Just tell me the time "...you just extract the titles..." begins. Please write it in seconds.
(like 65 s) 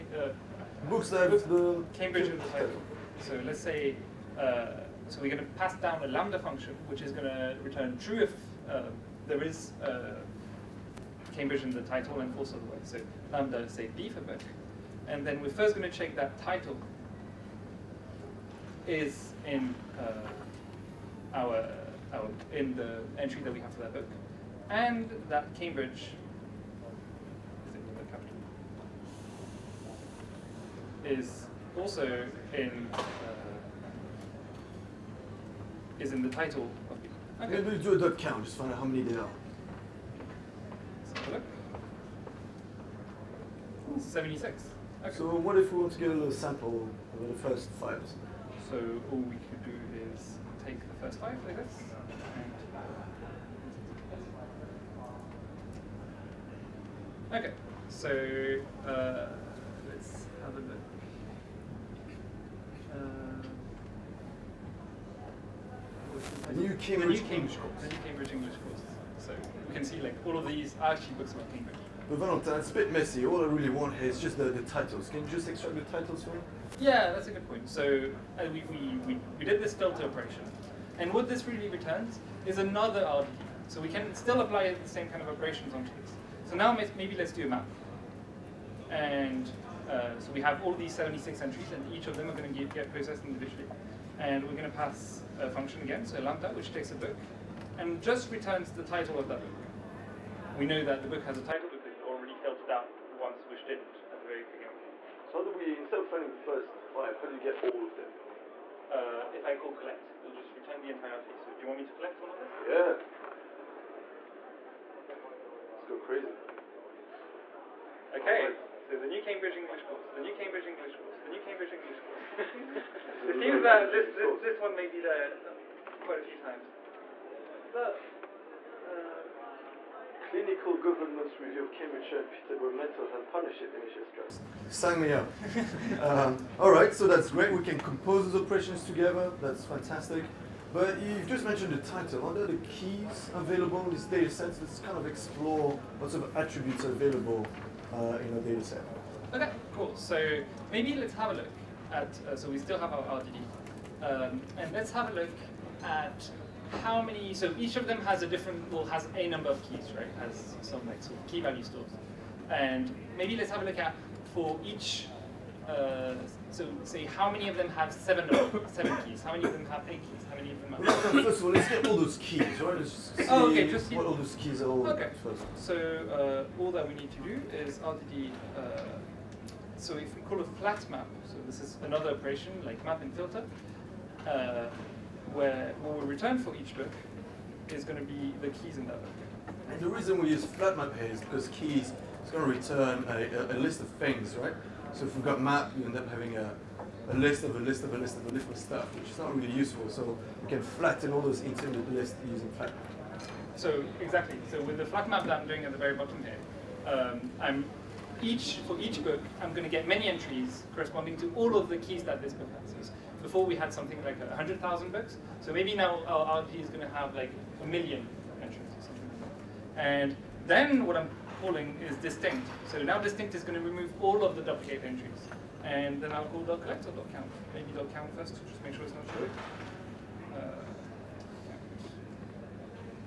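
75 s.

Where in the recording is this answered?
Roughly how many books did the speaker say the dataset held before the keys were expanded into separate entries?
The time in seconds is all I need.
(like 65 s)
214 s.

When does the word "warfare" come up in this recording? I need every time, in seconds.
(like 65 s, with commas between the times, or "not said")
not said.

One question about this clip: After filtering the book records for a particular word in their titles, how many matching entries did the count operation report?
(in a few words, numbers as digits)
76.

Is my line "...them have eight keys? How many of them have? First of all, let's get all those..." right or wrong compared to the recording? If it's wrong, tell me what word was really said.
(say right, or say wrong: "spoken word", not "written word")
right.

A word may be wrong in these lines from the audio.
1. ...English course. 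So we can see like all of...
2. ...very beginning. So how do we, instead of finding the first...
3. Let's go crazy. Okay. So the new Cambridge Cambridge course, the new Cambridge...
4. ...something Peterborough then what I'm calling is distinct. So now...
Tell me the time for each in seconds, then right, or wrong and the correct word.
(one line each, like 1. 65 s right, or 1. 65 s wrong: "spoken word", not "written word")
1. 68 s right
2. 104 s right
3. 115 s wrong: "English", not "Cambridge"
4. 218 s wrong: "And", not "Peterborough".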